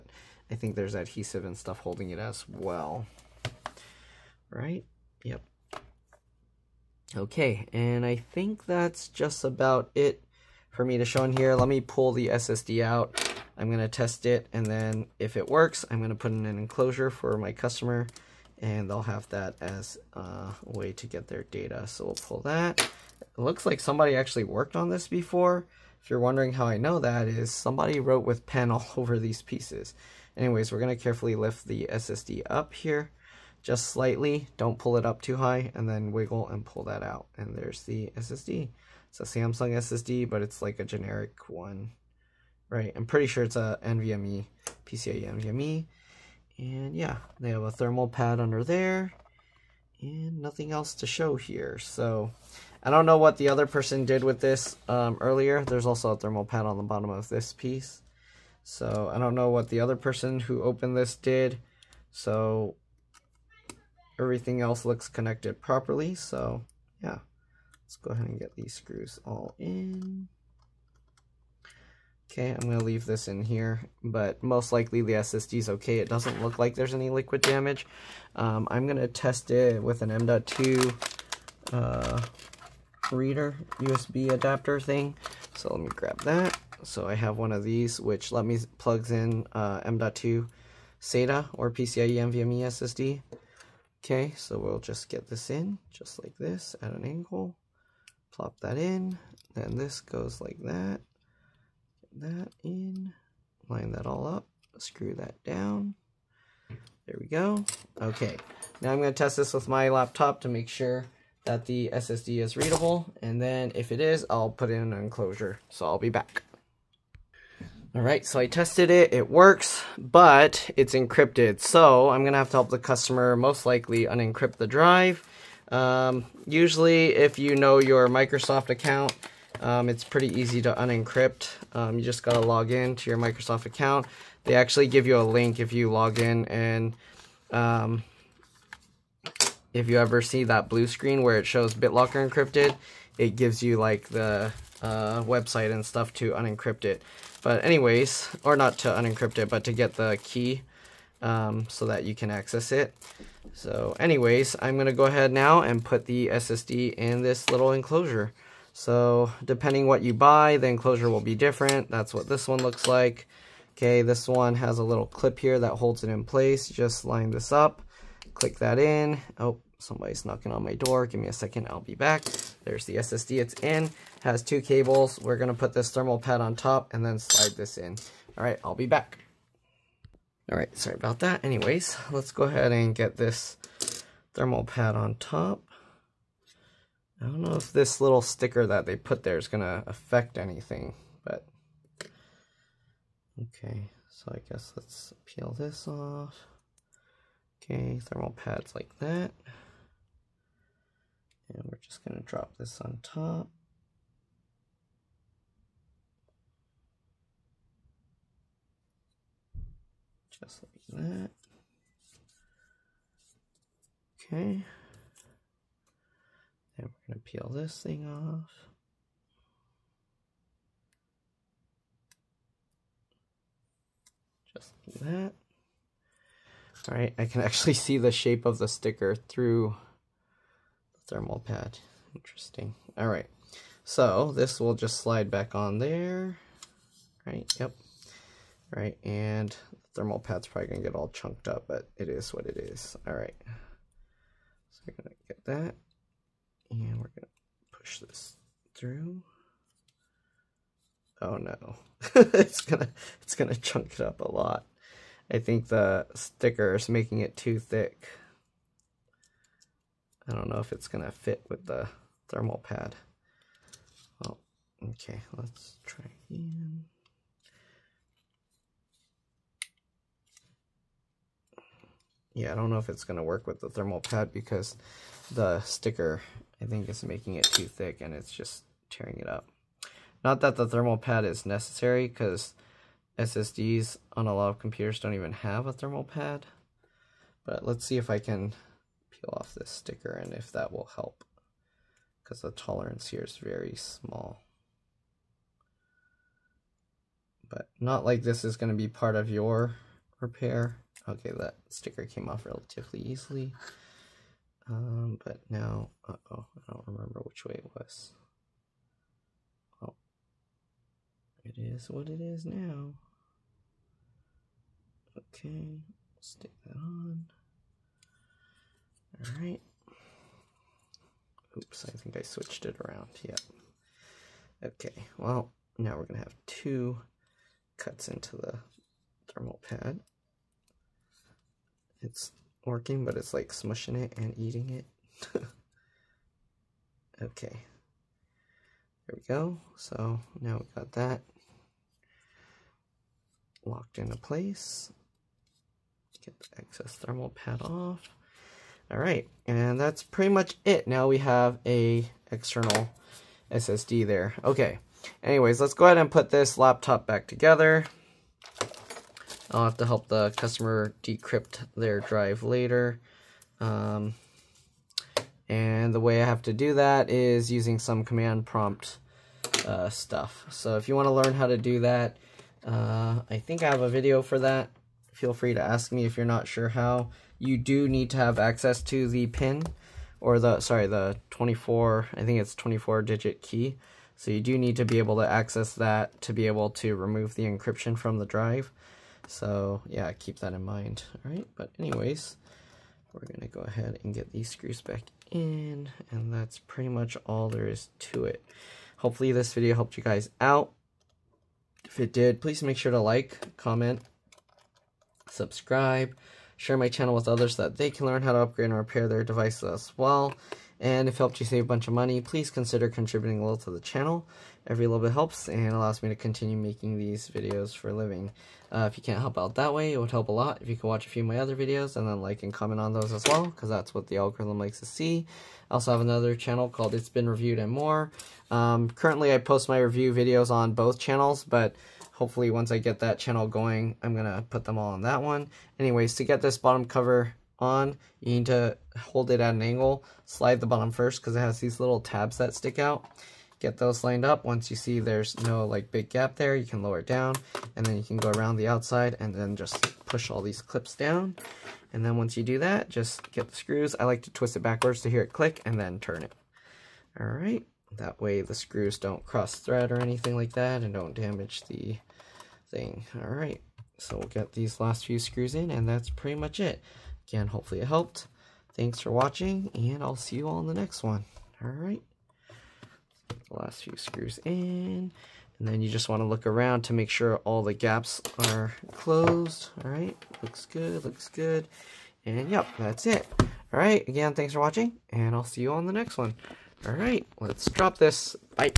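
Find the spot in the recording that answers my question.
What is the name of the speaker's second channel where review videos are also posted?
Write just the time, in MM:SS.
07:06.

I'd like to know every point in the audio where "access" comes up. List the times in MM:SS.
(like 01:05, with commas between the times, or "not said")
02:32, 06:18, 06:25.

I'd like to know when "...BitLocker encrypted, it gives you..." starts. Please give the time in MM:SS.
02:21.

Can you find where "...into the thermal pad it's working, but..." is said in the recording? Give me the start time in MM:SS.
05:28.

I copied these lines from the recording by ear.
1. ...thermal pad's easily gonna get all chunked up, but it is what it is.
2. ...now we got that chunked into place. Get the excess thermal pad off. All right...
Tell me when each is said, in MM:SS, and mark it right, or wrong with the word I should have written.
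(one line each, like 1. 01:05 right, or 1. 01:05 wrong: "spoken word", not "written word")
1. 03:59 wrong: "probably", not "easily"
2. 05:40 wrong: "locked", not "chunked".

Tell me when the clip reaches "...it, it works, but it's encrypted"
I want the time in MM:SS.
01:58.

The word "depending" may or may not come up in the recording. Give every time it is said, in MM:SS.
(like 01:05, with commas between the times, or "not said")
02:39.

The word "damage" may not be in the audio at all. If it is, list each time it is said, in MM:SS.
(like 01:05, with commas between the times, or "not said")
01:17, 07:41.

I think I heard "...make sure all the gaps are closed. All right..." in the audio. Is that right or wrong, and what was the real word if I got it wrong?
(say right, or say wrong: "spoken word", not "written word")
right.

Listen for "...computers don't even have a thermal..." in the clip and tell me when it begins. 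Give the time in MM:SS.
04:44.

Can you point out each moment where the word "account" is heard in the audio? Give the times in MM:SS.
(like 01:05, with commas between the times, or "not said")
02:08, 02:13.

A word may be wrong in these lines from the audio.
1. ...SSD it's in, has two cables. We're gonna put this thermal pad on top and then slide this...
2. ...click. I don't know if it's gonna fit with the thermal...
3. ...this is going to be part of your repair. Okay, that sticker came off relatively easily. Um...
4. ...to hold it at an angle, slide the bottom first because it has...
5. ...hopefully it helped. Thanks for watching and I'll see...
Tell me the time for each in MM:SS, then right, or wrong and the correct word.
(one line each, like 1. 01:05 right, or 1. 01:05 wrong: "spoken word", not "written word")
1. 02:52 right
2. 04:17 wrong: "thick", not "click"
3. 04:58 right
4. 07:18 right
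5. 07:47 right.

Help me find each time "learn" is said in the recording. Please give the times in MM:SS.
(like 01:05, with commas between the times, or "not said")
06:11, 06:48.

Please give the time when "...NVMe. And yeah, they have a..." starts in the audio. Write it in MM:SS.
00:45.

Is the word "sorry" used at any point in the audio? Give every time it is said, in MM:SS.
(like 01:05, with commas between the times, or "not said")
03:00, 06:20.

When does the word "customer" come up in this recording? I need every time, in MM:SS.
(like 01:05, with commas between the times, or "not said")
00:17, 02:02, 06:00.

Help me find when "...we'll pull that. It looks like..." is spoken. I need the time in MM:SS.
00:22.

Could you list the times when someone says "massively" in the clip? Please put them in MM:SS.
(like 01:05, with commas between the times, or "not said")
not said.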